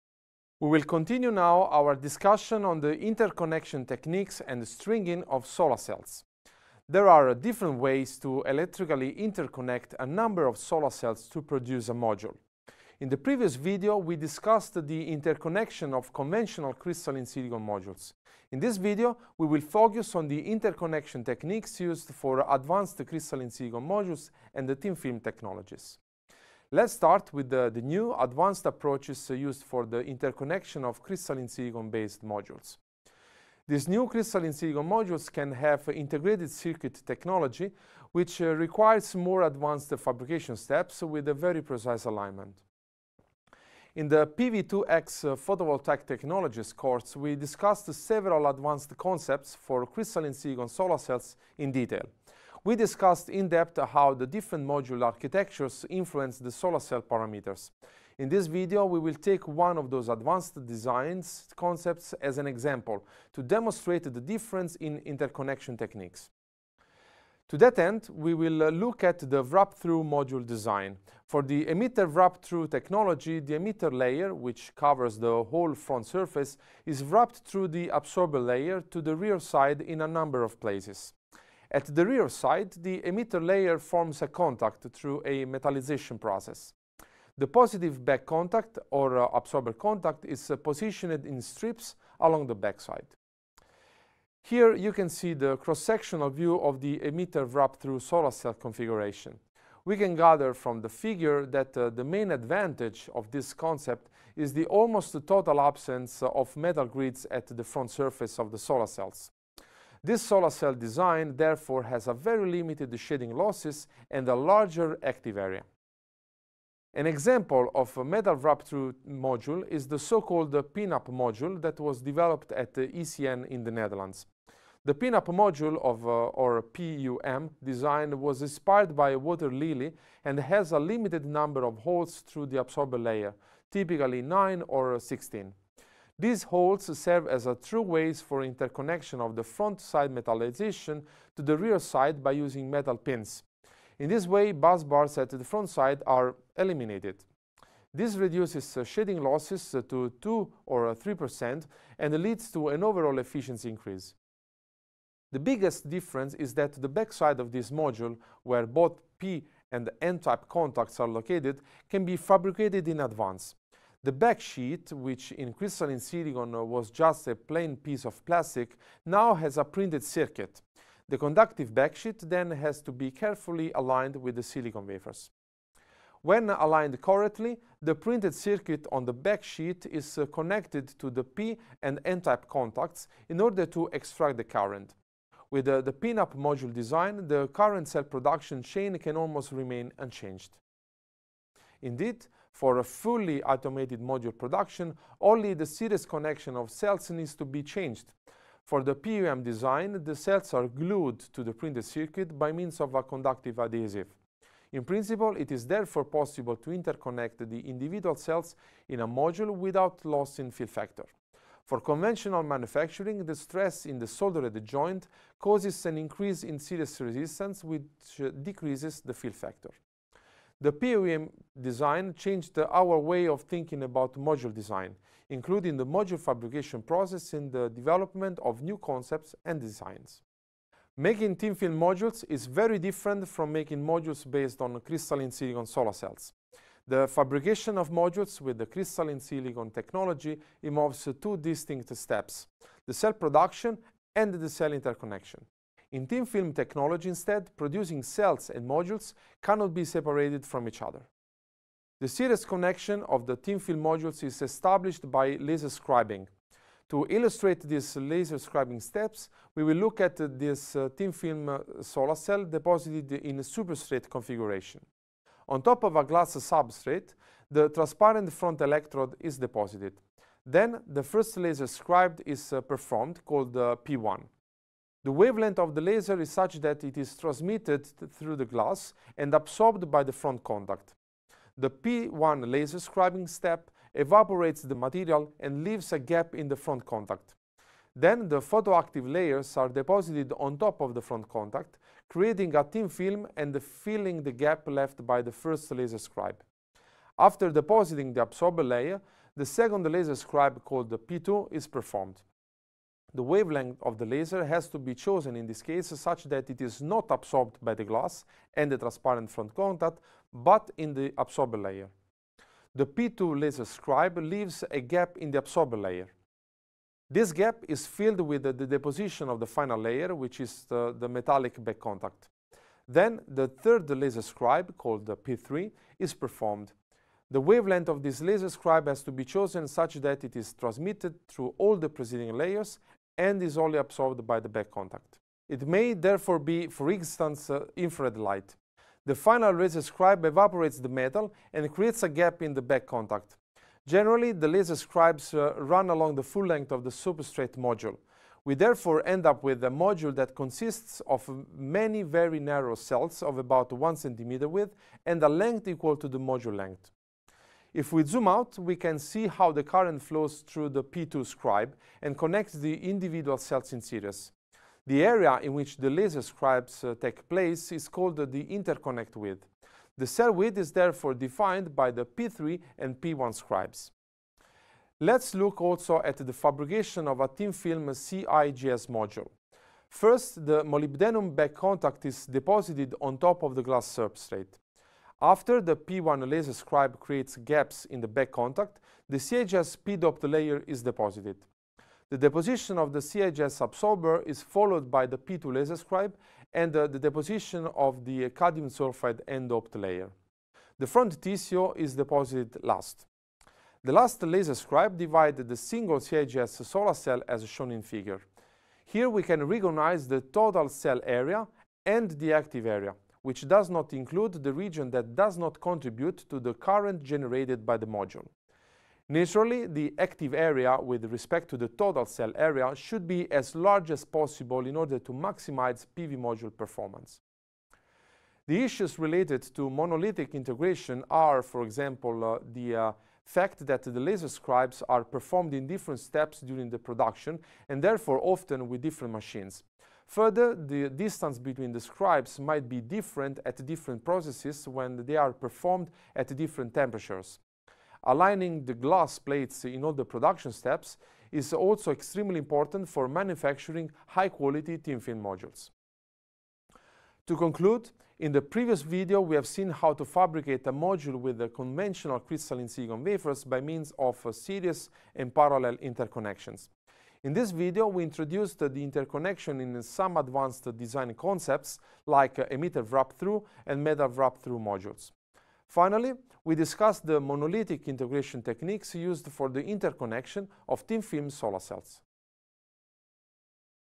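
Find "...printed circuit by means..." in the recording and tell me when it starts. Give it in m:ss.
3:21.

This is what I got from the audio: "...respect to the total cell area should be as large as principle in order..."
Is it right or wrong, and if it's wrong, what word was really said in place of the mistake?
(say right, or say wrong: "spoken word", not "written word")
wrong: "possible", not "principle".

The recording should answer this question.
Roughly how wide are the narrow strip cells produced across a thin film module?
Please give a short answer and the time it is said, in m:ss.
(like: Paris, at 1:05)
1 centimeter, at 5:53.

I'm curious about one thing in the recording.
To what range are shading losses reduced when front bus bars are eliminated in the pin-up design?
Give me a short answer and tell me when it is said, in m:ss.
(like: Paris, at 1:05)
2 or 3%, at 2:30.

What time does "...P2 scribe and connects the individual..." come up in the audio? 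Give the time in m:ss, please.
6:00.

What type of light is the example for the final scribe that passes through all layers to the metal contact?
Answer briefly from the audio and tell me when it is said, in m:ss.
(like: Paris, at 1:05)
Infrared light, at 5:37.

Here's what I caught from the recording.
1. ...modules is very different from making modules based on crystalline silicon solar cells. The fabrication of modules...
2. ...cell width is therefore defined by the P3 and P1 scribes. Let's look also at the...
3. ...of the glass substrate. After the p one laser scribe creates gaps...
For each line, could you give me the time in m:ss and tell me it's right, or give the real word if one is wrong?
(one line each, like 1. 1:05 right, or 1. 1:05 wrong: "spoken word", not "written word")
1. 3:51 right
2. 6:10 right
3. 6:23 right.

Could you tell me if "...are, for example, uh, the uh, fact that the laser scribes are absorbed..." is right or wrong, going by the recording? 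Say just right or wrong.
wrong.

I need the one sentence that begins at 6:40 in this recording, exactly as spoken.
The front TCO is deposited last.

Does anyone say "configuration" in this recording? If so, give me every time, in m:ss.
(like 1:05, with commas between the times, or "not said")
1:38, 4:24.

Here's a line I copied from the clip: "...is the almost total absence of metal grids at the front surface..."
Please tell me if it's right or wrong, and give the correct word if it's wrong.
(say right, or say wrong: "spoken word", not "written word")
right.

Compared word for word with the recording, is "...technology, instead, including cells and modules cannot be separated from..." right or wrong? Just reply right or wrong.
wrong.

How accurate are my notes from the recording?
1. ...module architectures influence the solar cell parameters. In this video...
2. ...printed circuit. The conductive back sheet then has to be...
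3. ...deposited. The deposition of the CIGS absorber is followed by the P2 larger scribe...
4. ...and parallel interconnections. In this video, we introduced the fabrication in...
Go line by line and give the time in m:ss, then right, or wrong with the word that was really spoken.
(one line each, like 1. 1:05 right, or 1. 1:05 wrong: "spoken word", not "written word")
1. 0:54 right
2. 2:49 right
3. 6:30 wrong: "laser", not "larger"
4. 7:45 wrong: "interconnection", not "fabrication".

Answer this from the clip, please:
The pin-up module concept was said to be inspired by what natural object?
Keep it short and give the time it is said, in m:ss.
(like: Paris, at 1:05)
A water lily, at 2:09.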